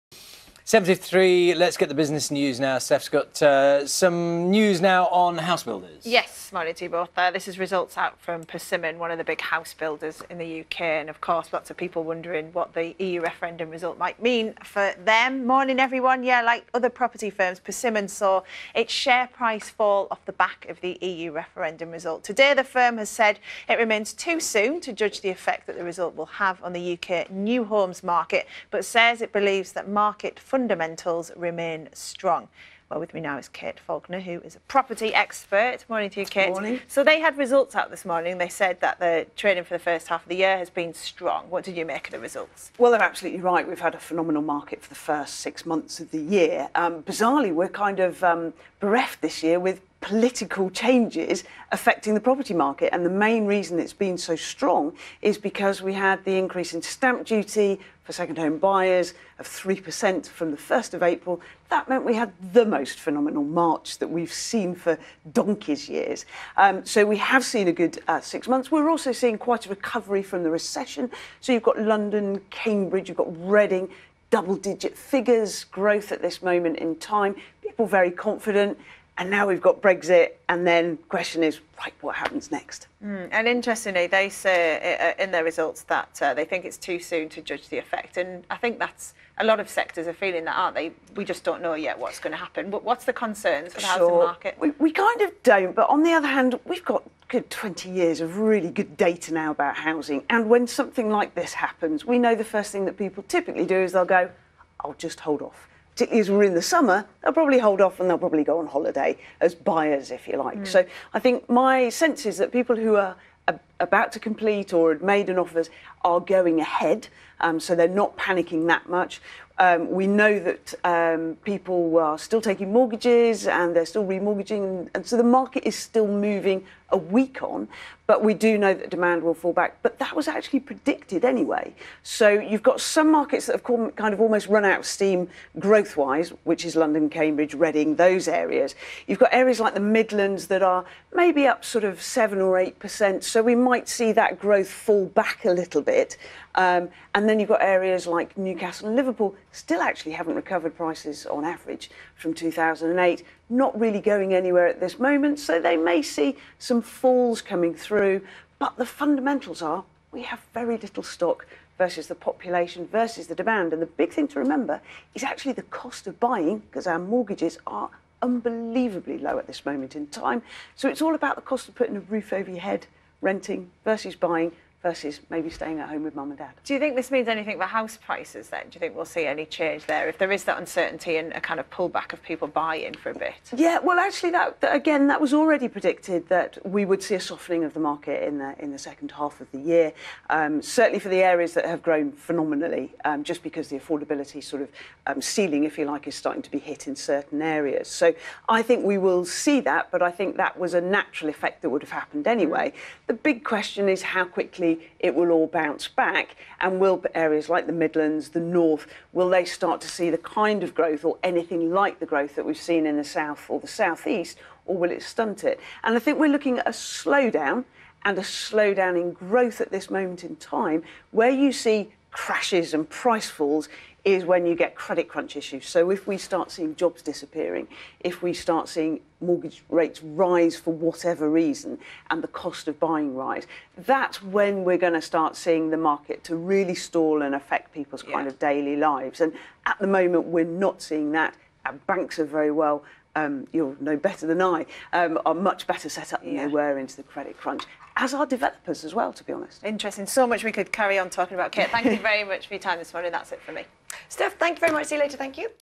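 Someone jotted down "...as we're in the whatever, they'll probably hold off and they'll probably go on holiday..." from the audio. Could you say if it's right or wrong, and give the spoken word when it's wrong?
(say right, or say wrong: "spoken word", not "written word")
wrong: "summer", not "whatever".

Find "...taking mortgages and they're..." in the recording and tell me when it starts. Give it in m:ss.
2:02.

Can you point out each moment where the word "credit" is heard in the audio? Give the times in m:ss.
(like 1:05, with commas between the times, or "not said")
3:44, 4:07.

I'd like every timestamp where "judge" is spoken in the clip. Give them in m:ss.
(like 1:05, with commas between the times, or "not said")
0:24, 1:27.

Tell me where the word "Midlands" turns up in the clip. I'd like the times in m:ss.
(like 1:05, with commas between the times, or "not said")
2:19, 3:27.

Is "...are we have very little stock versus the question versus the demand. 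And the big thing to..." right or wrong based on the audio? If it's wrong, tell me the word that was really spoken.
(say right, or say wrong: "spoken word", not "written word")
wrong: "population", not "question".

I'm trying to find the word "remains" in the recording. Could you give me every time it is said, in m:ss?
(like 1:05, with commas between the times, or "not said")
0:23, 0:31.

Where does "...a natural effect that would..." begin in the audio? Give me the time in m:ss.
3:20.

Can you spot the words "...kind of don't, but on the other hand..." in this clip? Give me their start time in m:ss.
1:34.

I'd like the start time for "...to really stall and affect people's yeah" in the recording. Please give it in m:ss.
3:56.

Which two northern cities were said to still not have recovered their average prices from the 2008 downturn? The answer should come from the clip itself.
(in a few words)
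Newcastle and Liverpool.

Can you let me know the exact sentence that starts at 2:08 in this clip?
But we do know that demand will fall back.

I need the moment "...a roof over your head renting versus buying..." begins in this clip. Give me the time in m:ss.
2:51.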